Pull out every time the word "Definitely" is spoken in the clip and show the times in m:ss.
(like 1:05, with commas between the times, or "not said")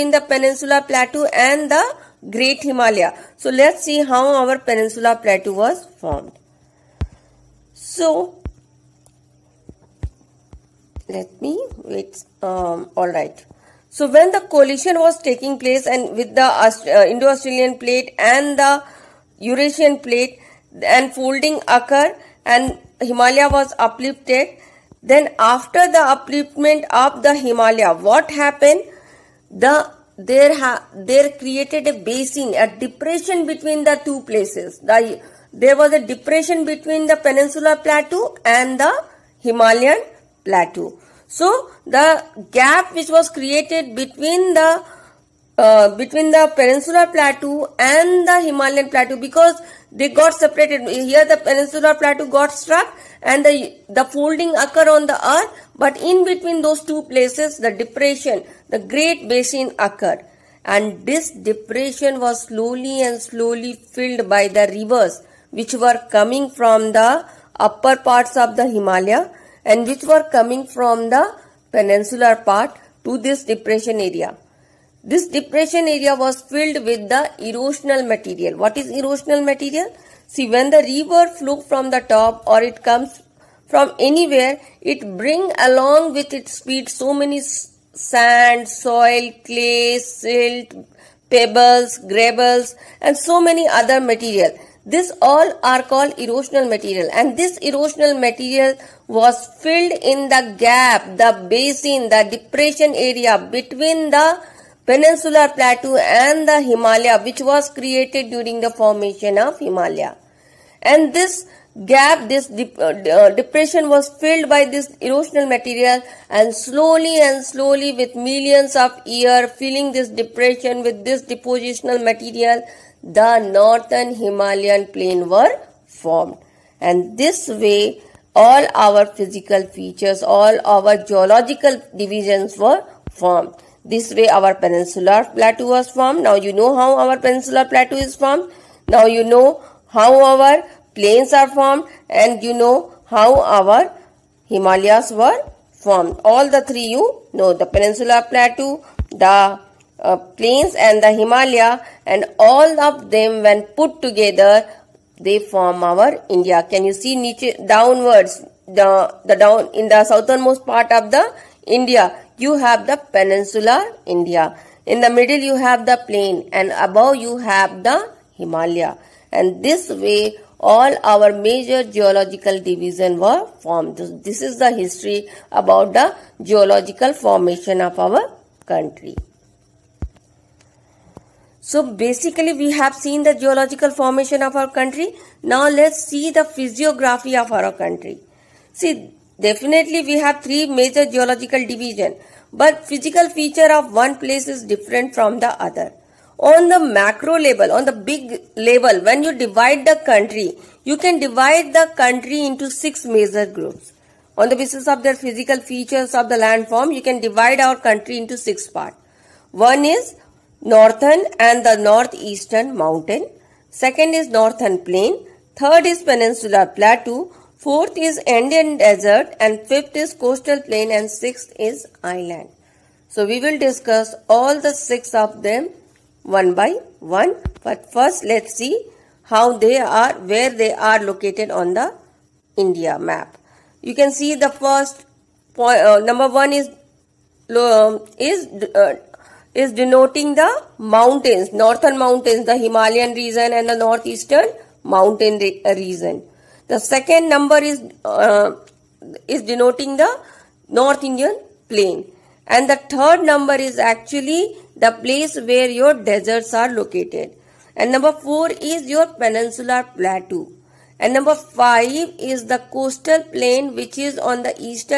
3:09.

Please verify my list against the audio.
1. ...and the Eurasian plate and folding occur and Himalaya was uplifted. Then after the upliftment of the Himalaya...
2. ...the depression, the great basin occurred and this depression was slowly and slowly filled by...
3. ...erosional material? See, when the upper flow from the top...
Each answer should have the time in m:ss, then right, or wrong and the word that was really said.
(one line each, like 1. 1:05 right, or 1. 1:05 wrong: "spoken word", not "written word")
1. 0:18 right
2. 0:57 right
3. 1:18 wrong: "river", not "upper".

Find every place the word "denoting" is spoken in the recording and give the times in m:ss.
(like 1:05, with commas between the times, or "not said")
3:59, 4:09.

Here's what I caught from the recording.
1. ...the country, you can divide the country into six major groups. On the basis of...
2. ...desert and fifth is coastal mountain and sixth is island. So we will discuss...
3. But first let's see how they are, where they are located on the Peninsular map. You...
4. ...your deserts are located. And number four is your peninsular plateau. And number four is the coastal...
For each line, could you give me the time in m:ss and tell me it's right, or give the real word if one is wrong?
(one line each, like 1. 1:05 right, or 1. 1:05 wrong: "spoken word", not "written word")
1. 3:19 right
2. 3:38 wrong: "plain", not "mountain"
3. 3:47 wrong: "India", not "Peninsular"
4. 4:15 wrong: "five", not "four".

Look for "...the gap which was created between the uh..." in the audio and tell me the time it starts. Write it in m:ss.
0:41.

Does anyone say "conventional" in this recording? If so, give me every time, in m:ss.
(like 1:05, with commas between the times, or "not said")
not said.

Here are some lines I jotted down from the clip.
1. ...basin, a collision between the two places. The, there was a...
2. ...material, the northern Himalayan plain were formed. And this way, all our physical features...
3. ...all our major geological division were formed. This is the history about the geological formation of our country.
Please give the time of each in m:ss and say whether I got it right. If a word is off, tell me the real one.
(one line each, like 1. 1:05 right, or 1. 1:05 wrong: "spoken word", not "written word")
1. 0:31 wrong: "depression", not "collision"
2. 2:02 right
3. 2:50 right.